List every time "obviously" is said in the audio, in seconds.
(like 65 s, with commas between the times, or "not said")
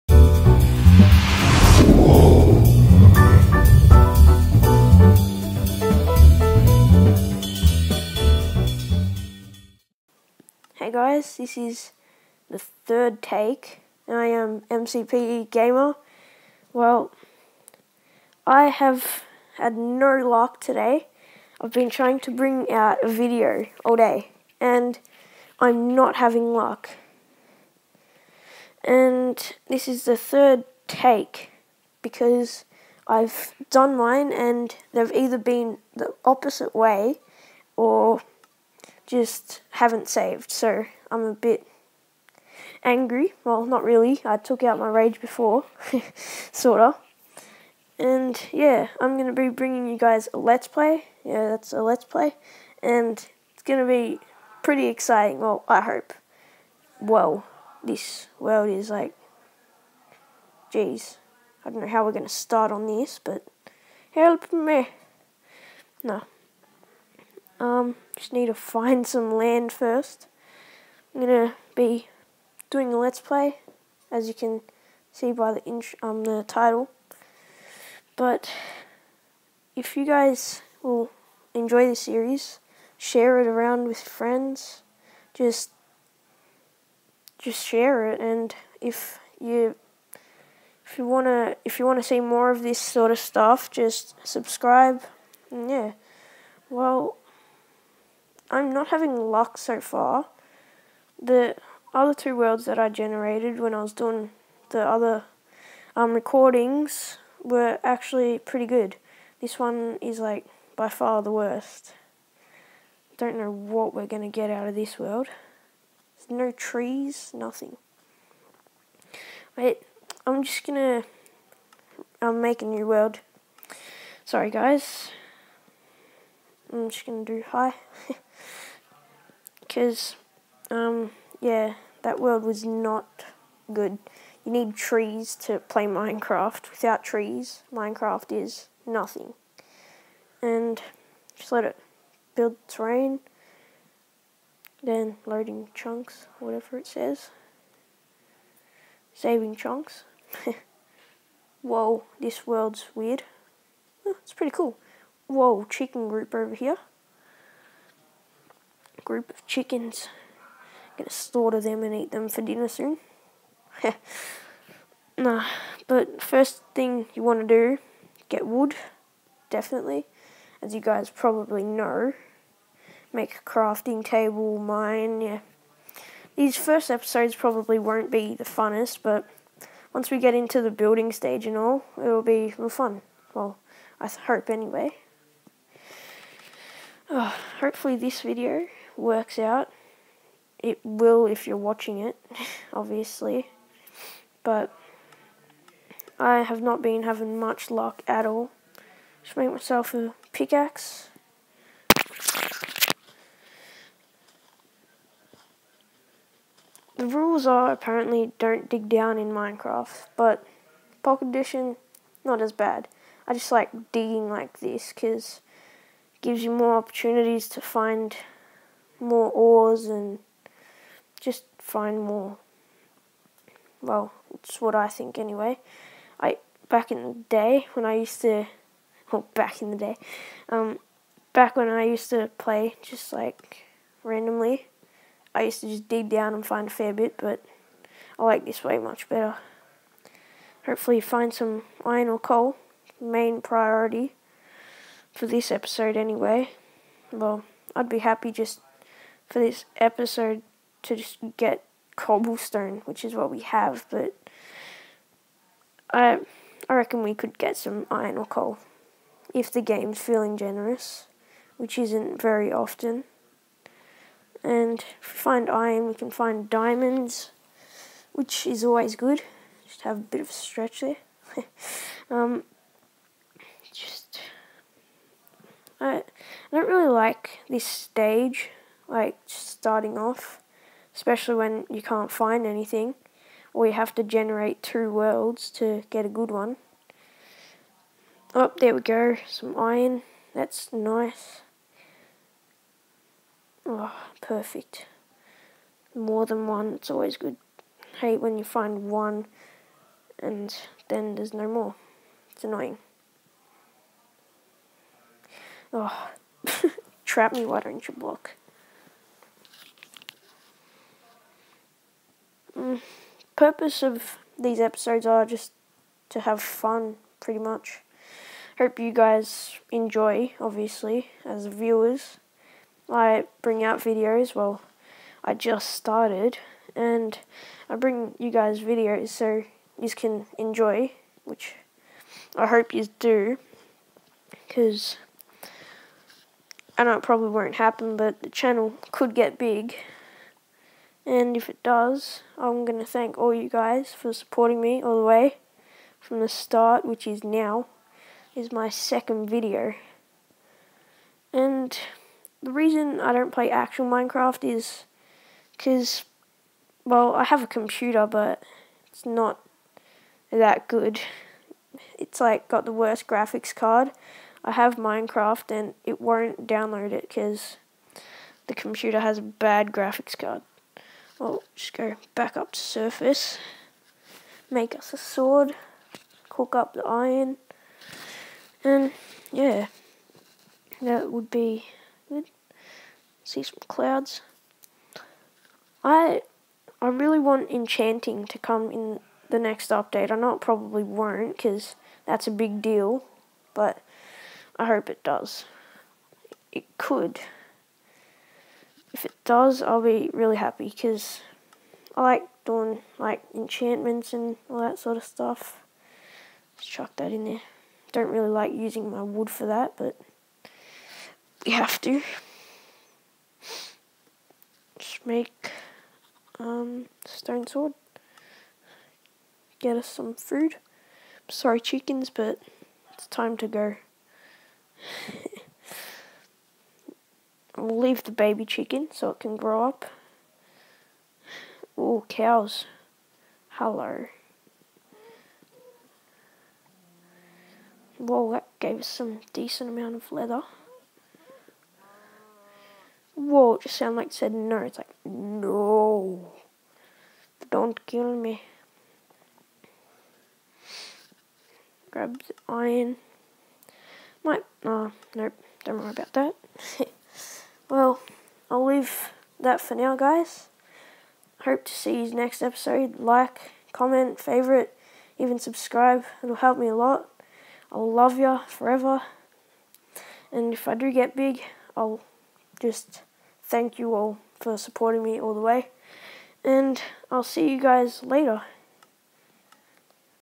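192 s, 320 s.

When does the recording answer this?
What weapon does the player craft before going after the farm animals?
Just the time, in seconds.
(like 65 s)
417 s.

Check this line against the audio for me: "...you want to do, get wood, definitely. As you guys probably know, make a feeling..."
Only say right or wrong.
wrong.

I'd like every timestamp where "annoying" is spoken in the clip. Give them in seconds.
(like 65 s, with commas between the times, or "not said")
302 s.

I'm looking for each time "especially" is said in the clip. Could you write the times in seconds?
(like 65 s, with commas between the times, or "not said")
280 s.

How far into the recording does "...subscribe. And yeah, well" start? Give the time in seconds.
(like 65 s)
94 s.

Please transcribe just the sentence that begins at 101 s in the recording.
The other two worlds that I generated when I was doing the other um, recordings were actually pretty good.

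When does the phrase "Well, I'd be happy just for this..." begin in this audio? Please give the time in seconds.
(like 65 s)
247 s.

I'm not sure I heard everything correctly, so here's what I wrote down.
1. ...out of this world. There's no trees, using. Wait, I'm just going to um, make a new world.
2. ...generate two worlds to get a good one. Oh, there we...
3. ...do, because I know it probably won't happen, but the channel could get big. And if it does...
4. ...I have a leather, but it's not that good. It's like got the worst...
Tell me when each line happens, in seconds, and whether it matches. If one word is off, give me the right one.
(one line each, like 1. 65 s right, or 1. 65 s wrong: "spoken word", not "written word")
1. 114 s wrong: "nothing", not "using"
2. 284 s right
3. 332 s right
4. 357 s wrong: "computer", not "leather".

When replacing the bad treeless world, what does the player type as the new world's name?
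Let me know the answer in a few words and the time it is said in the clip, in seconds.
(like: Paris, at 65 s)
hi, at 127 s.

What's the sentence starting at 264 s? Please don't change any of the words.
And if we find iron, we can find diamonds, which is always good.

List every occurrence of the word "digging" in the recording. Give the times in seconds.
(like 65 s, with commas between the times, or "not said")
213 s.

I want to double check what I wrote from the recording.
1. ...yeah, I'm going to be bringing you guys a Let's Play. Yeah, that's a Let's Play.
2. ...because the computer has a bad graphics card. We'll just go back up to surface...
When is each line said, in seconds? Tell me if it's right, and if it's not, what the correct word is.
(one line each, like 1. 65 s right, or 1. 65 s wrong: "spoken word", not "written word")
1. 48 s right
2. 367 s right.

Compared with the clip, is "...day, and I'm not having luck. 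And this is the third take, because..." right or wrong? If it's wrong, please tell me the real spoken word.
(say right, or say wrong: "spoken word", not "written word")
right.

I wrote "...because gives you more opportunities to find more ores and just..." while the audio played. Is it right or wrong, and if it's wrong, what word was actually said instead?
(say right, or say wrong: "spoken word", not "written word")
right.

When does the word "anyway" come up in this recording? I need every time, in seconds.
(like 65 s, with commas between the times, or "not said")
184 s, 225 s, 245 s.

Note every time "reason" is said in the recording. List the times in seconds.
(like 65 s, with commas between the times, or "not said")
352 s.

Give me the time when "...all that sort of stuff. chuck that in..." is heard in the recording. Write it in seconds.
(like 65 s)
404 s.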